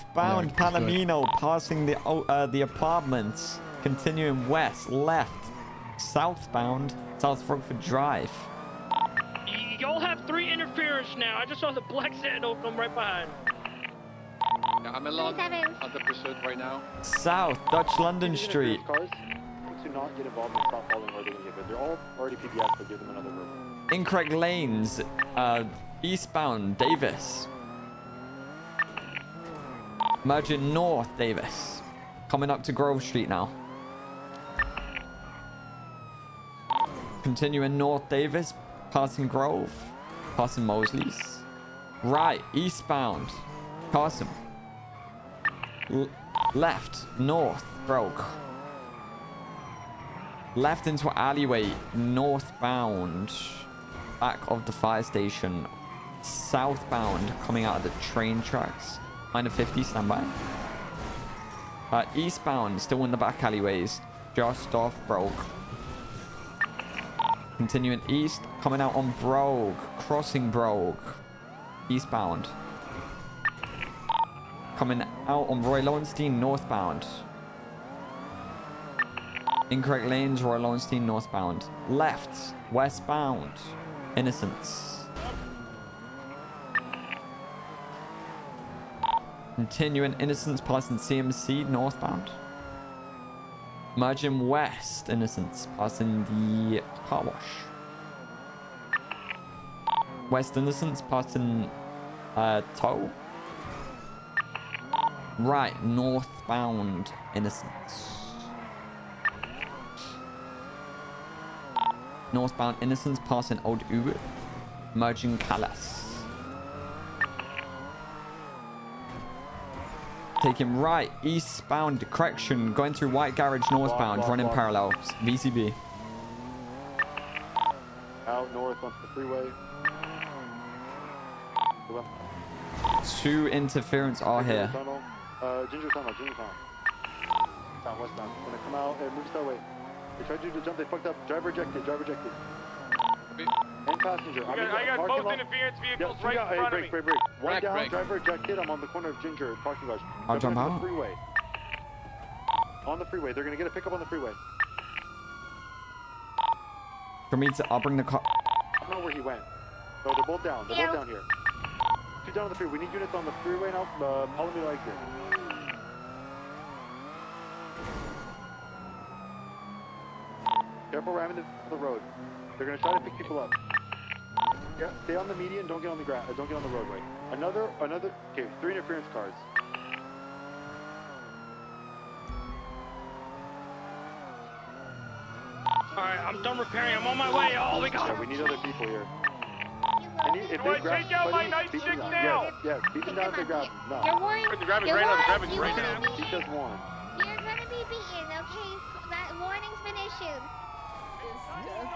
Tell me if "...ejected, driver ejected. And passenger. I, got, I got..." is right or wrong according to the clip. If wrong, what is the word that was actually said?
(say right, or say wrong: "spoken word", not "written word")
right.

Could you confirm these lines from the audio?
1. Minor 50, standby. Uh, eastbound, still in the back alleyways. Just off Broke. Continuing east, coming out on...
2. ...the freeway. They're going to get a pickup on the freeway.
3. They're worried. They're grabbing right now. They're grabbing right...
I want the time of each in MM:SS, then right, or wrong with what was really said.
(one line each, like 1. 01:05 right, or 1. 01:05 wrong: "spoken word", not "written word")
1. 00:59 right
2. 02:32 right
3. 03:14 right.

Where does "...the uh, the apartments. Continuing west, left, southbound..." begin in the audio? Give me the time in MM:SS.
00:01.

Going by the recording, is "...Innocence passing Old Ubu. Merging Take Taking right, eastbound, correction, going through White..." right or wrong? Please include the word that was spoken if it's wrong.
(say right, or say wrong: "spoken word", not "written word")
right.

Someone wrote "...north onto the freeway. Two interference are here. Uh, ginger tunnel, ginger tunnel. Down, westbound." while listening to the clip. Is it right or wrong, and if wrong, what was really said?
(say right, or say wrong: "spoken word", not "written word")
right.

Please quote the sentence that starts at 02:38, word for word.
I don't know where he went.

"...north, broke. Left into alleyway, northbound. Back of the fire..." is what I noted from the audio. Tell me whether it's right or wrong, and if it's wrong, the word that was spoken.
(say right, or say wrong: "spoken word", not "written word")
right.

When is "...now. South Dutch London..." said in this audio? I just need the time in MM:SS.
00:16.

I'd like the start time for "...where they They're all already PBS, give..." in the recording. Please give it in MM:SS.
00:21.